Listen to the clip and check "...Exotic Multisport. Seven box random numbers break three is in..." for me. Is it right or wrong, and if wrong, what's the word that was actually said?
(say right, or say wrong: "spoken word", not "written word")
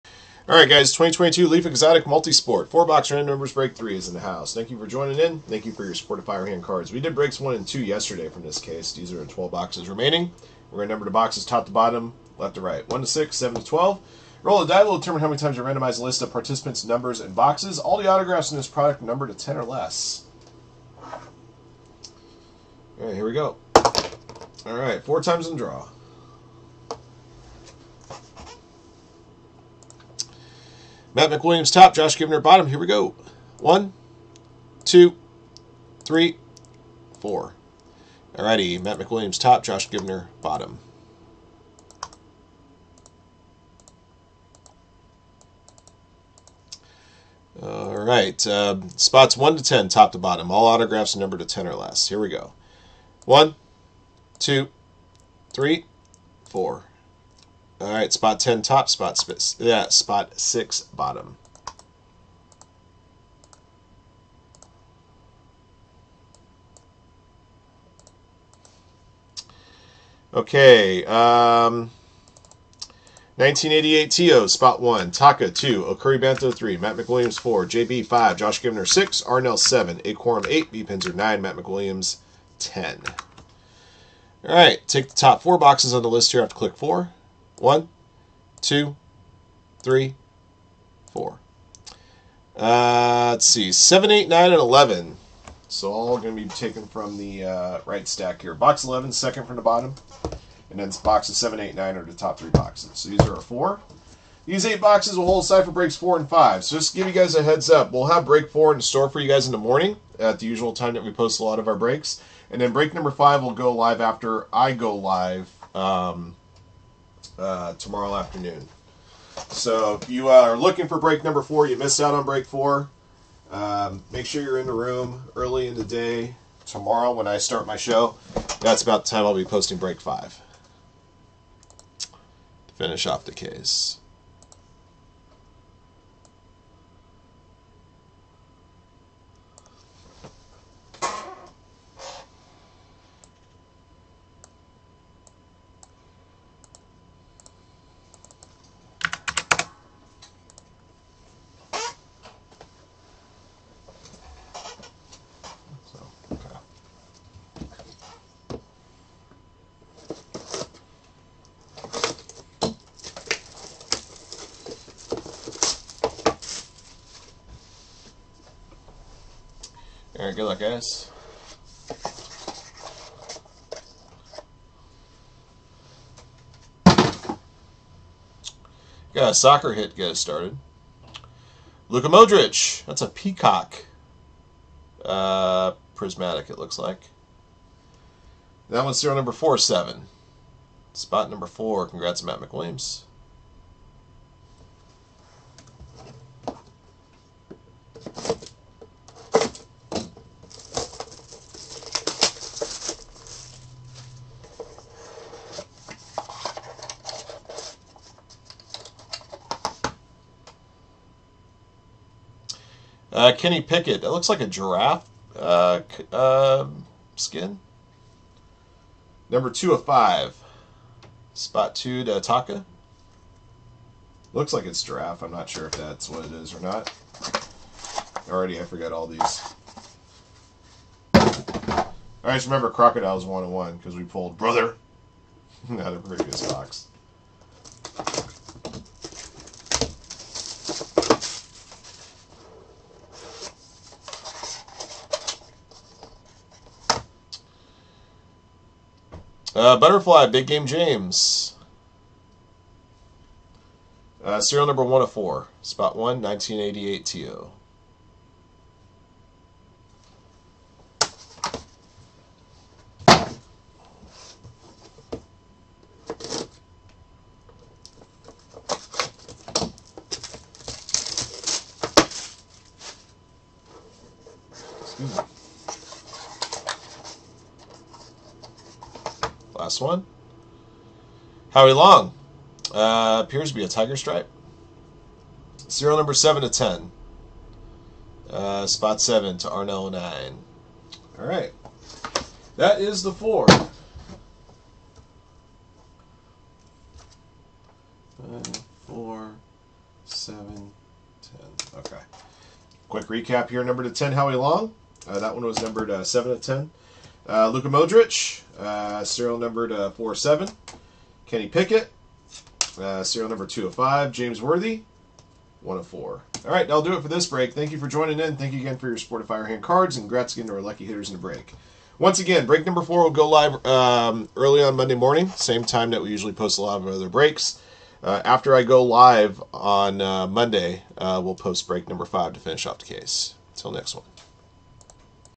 wrong: "Four", not "Seven".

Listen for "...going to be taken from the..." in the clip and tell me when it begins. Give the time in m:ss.
1:36.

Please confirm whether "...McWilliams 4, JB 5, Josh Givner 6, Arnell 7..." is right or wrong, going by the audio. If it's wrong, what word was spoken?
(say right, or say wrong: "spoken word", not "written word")
right.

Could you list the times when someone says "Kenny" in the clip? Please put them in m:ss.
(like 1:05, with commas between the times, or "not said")
3:33, 5:11.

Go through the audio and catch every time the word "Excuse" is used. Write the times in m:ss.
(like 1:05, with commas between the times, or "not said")
4:34.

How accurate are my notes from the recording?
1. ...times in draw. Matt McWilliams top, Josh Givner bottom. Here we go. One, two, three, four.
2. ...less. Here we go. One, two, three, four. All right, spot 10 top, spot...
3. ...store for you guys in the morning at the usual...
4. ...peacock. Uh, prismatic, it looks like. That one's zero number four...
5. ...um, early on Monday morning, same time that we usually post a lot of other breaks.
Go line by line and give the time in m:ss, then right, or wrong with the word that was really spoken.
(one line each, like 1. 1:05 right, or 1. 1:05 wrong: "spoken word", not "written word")
1. 0:25 right
2. 0:51 right
3. 1:48 right
4. 3:03 right
5. 5:23 right.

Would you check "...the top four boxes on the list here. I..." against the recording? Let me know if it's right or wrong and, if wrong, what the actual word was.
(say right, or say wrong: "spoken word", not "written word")
right.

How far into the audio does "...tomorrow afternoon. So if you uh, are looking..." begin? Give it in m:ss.
1:57.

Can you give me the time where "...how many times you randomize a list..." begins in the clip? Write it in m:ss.
0:15.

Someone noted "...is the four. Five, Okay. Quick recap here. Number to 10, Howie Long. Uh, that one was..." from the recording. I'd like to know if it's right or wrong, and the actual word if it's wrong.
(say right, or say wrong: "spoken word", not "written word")
right.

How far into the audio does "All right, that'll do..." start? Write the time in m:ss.
5:16.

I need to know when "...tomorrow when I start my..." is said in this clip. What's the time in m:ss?
2:06.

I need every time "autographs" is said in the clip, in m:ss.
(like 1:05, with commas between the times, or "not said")
0:18, 0:50.